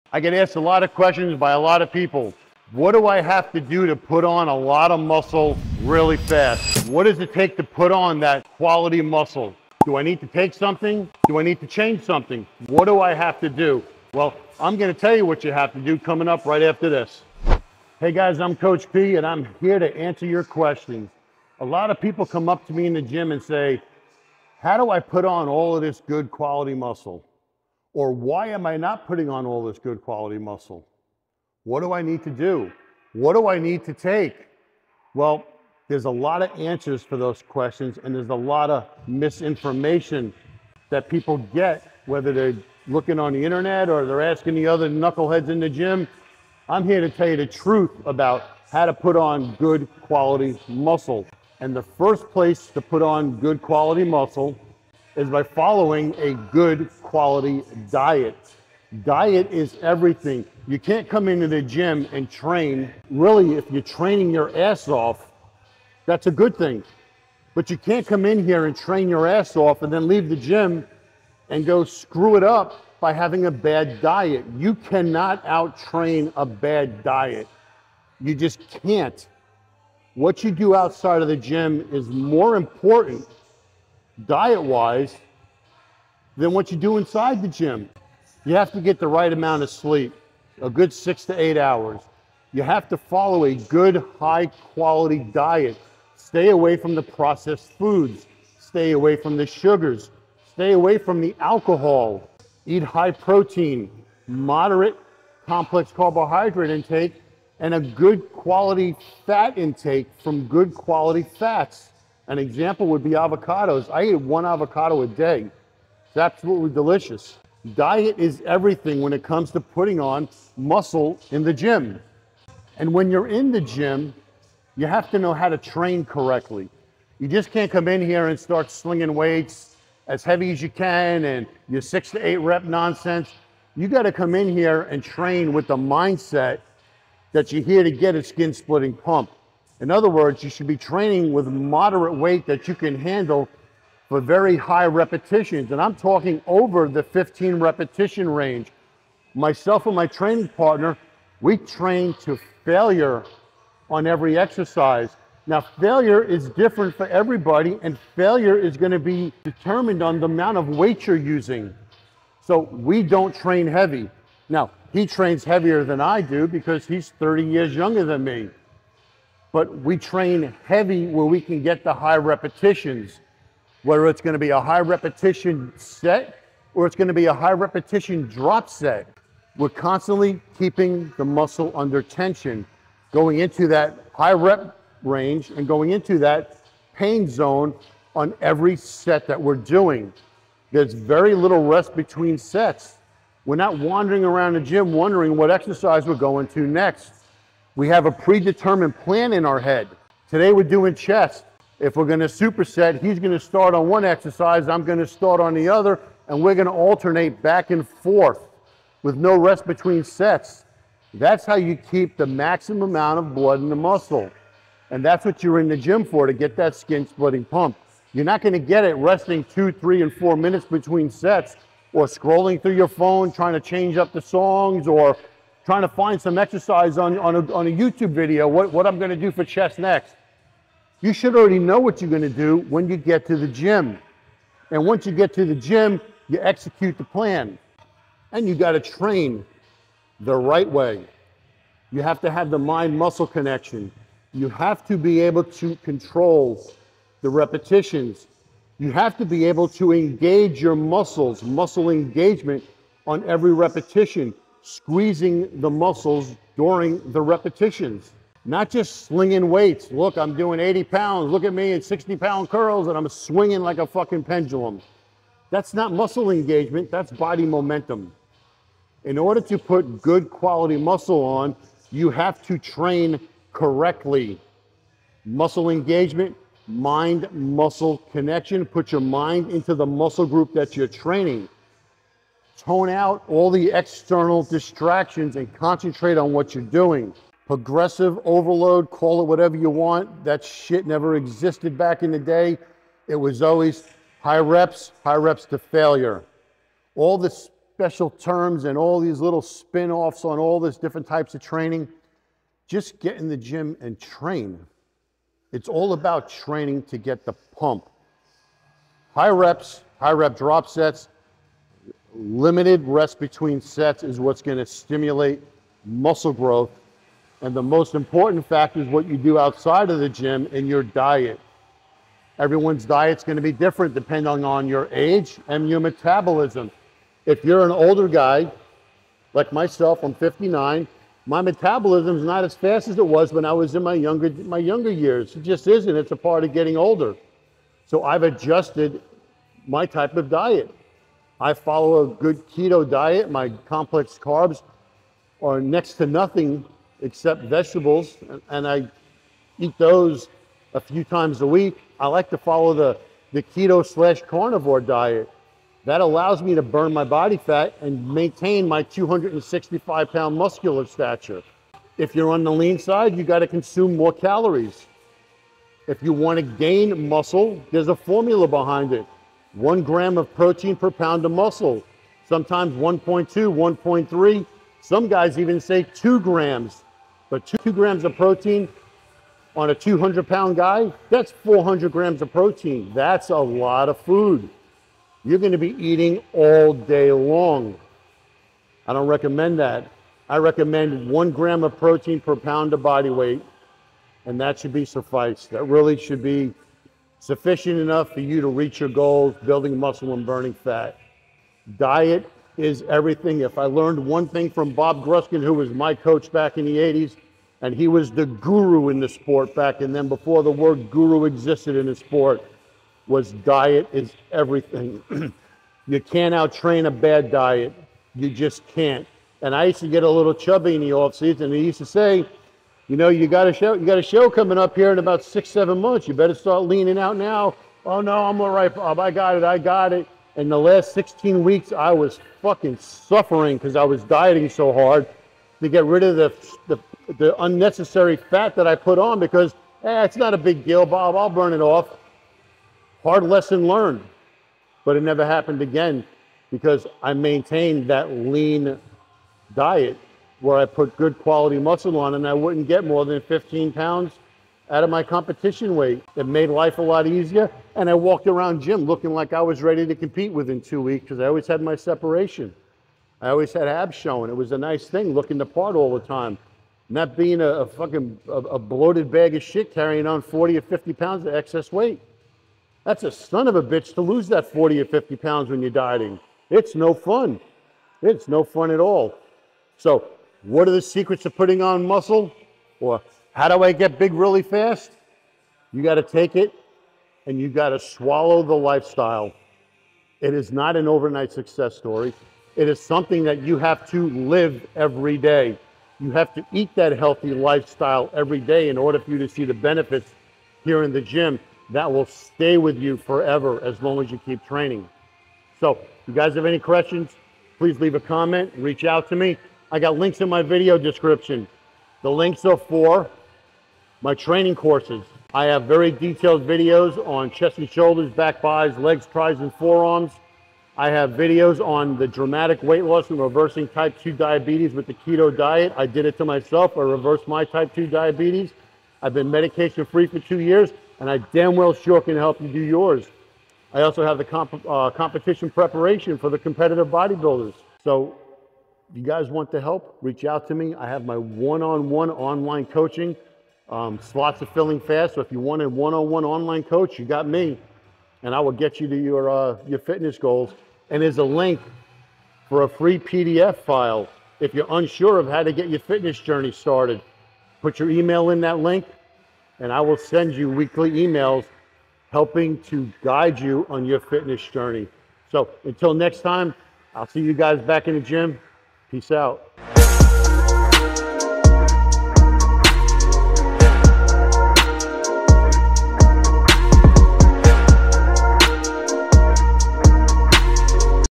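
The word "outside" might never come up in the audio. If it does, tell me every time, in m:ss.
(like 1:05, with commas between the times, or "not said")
1:20, 5:19.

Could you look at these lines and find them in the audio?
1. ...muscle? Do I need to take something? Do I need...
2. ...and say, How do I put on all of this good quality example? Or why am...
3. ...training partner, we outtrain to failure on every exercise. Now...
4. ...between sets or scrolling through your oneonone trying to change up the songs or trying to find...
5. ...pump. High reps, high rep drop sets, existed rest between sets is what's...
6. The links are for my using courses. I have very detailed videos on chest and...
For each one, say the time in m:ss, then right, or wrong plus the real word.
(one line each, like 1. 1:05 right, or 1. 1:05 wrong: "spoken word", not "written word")
1. 0:09 right
2. 0:23 wrong: "muscle", not "example"
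3. 2:30 wrong: "train", not "outtrain"
4. 3:40 wrong: "phone", not "oneonone"
5. 5:07 wrong: "limited", not "existed"
6. 8:32 wrong: "training", not "using".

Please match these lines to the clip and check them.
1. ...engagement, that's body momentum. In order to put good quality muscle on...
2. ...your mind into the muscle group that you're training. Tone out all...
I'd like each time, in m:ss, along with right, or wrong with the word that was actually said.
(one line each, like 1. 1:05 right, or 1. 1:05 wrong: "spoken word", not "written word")
1. 4:26 right
2. 4:38 right.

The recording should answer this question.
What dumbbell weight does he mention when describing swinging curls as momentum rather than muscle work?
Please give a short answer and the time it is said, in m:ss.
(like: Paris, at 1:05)
60 pounds, at 4:21.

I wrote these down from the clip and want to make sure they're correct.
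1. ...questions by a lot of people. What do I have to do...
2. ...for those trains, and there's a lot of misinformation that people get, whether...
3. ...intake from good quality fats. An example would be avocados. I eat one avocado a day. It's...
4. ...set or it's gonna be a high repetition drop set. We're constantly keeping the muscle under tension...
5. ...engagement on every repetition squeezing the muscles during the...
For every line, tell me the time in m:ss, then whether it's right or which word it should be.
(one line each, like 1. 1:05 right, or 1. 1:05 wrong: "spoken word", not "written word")
1. 0:00 right
2. 0:37 wrong: "questions", not "trains"
3. 1:49 right
4. 2:55 right
5. 4:11 right.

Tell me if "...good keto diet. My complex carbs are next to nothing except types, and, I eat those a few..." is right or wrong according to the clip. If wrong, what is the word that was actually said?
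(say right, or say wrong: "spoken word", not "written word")
wrong: "vegetables", not "types".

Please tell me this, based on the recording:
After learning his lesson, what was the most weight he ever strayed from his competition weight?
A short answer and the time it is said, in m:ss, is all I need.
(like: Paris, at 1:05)
15 pounds, at 7:33.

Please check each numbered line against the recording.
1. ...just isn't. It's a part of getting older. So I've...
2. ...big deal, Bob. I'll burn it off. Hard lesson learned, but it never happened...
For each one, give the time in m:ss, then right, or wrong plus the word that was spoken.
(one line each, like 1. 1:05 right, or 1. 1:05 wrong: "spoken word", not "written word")
1. 5:35 right
2. 7:20 right.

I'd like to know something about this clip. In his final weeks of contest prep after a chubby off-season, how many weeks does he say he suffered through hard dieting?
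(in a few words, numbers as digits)
16 weeks.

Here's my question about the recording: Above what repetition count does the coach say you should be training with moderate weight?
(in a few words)
15.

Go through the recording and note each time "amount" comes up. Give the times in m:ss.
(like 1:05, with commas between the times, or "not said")
1:29, 2:40, 3:32.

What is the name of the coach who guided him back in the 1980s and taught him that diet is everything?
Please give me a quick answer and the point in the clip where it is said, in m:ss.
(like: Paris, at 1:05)
Bob Gruskin, at 6:44.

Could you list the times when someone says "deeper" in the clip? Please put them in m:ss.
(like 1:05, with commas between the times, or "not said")
not said.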